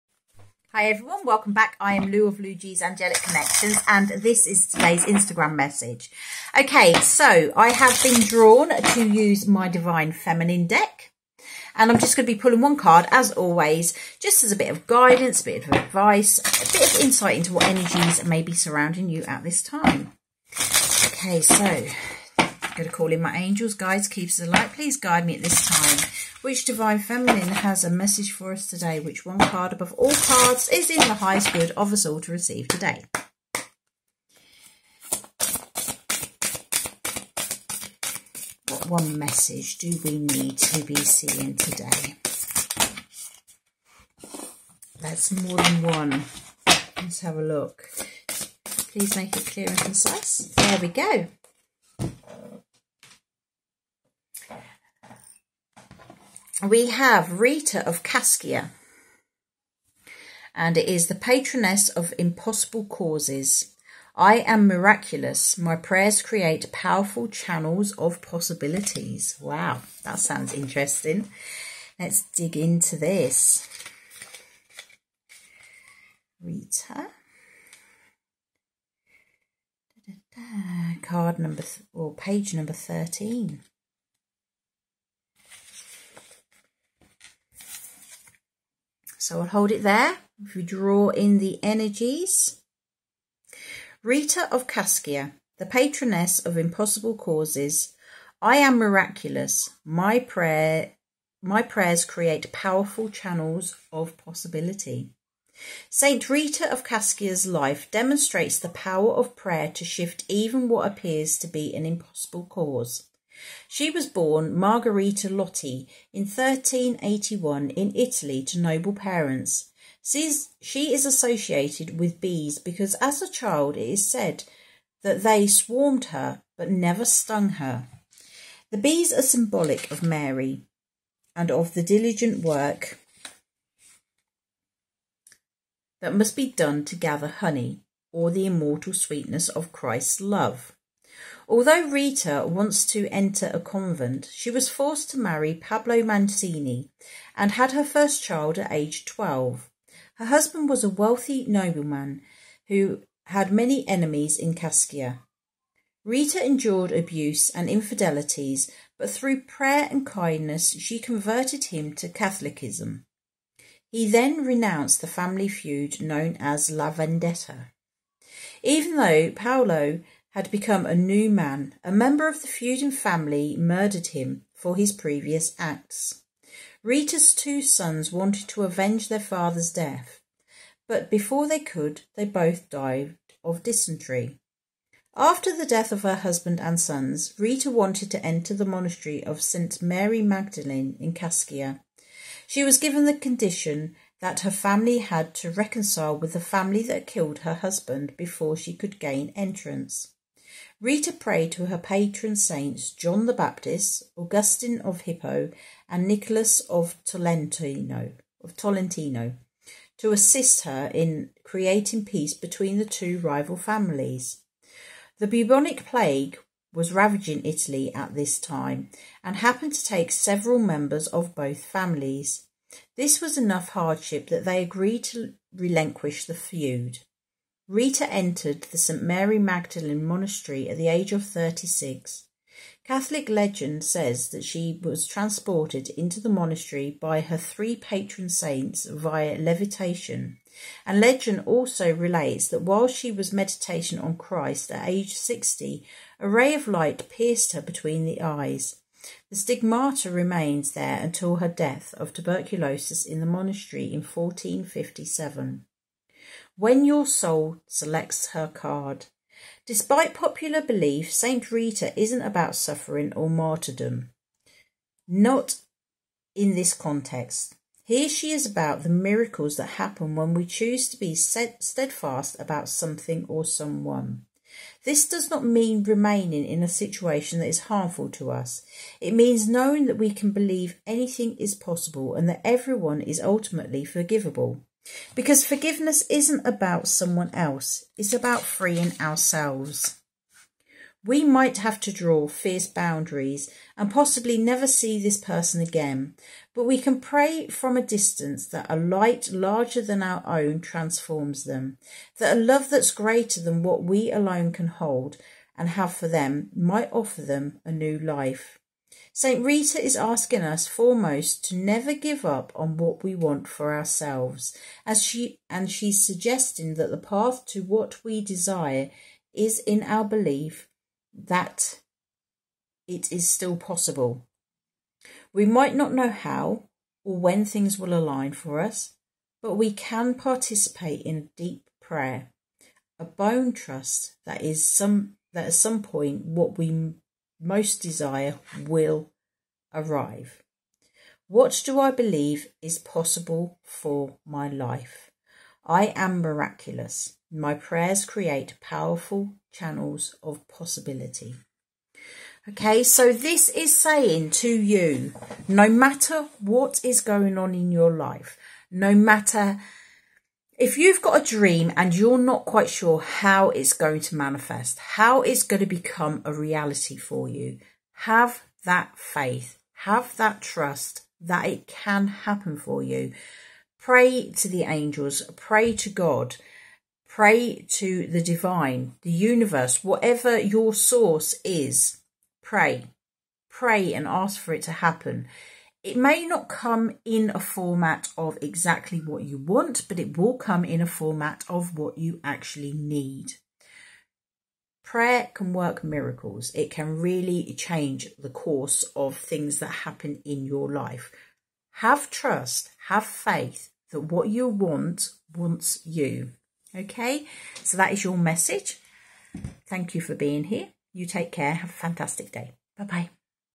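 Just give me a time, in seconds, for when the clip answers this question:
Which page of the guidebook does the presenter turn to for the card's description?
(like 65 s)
82 s.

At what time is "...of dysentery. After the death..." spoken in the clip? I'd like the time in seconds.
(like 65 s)
183 s.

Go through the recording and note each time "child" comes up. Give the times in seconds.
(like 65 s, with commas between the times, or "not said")
123 s, 148 s.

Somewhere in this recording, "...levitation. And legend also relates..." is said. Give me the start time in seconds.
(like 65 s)
239 s.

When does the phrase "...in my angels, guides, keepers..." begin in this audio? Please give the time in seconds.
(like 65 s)
23 s.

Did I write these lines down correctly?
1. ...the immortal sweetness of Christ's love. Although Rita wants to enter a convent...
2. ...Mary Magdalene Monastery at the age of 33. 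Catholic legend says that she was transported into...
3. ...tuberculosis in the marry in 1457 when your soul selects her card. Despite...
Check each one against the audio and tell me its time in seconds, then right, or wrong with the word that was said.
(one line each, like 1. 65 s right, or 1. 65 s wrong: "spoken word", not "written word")
1. 138 s right
2. 229 s wrong: "36", not "33"
3. 252 s wrong: "monastery", not "marry".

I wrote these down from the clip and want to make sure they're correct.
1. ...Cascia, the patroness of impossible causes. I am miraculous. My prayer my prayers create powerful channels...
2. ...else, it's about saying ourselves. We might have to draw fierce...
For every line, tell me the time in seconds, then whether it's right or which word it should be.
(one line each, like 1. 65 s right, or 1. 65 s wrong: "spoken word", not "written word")
1. 94 s right
2. 287 s wrong: "freeing", not "saying".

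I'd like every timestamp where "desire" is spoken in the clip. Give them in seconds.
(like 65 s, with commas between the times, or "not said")
318 s, 337 s.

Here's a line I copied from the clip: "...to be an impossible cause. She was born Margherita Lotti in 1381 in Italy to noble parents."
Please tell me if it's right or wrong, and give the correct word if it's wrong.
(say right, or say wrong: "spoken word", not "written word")
right.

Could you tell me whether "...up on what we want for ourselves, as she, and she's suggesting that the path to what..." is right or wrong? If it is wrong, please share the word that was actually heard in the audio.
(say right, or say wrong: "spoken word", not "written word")
right.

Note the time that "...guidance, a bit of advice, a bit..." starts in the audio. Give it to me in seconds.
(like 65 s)
14 s.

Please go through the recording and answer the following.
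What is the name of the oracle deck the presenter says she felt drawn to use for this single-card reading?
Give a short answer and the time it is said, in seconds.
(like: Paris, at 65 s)
Divine Feminine deck, at 9 s.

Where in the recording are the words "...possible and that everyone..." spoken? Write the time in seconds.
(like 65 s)
281 s.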